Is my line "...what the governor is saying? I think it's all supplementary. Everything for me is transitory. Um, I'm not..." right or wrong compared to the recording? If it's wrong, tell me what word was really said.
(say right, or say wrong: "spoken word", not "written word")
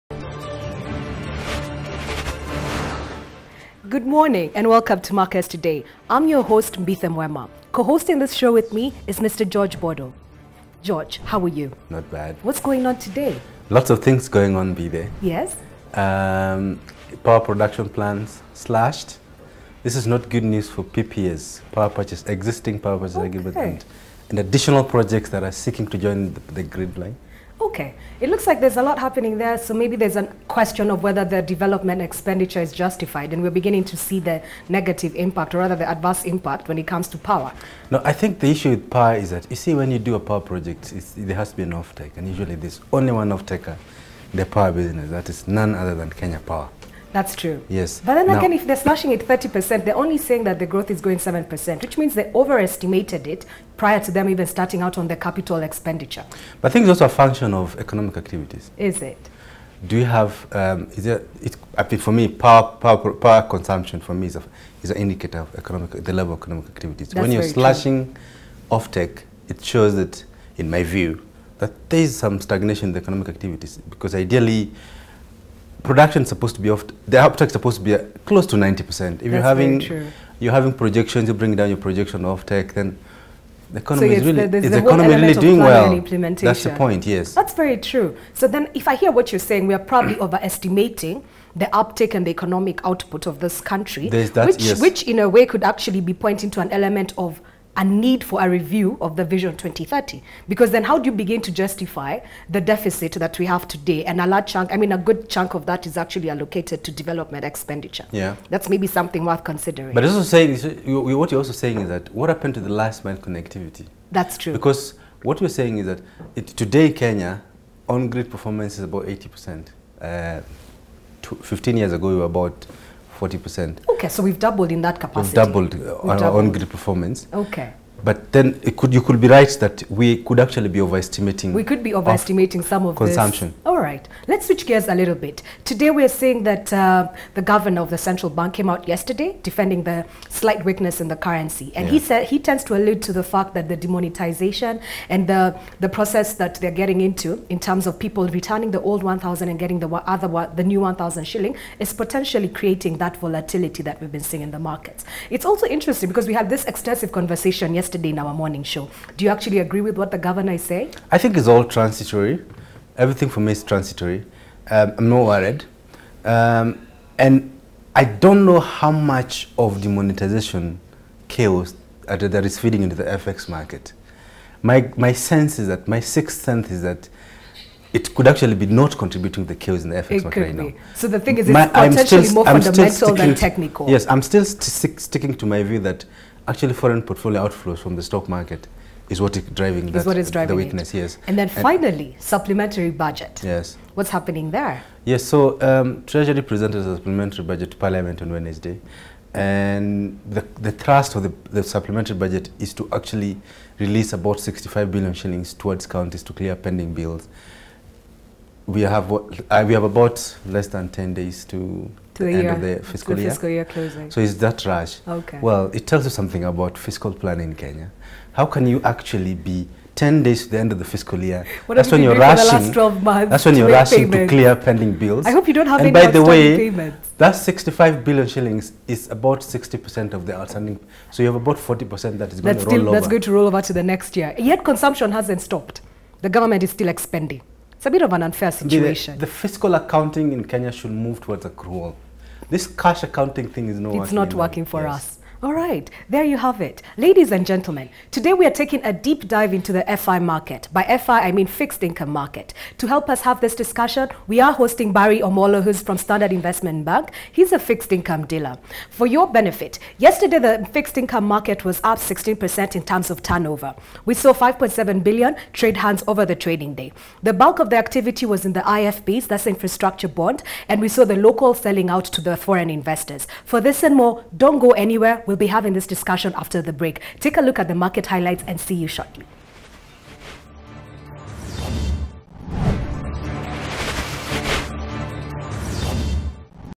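wrong: "transitory", not "supplementary".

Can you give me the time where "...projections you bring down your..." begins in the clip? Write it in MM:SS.
01:20.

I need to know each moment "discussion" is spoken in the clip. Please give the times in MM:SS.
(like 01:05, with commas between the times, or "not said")
04:13, 04:35.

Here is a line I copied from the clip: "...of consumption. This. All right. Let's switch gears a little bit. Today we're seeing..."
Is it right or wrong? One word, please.
right.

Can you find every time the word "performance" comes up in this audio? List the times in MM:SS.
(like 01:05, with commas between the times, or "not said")
01:58, 02:06.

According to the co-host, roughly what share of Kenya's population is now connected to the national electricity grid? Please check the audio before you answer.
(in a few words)
80%.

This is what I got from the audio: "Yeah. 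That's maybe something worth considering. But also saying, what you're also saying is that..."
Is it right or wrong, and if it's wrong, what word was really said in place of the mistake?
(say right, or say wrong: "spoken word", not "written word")
right.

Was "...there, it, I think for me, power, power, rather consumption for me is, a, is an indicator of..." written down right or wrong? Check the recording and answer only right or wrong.
wrong.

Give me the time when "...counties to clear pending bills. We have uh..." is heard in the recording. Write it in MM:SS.
03:25.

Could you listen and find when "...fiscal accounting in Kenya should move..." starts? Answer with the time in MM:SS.
03:59.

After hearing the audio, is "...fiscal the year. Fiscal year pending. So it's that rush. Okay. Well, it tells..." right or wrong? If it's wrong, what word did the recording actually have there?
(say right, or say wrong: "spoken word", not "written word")
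wrong: "closing", not "pending".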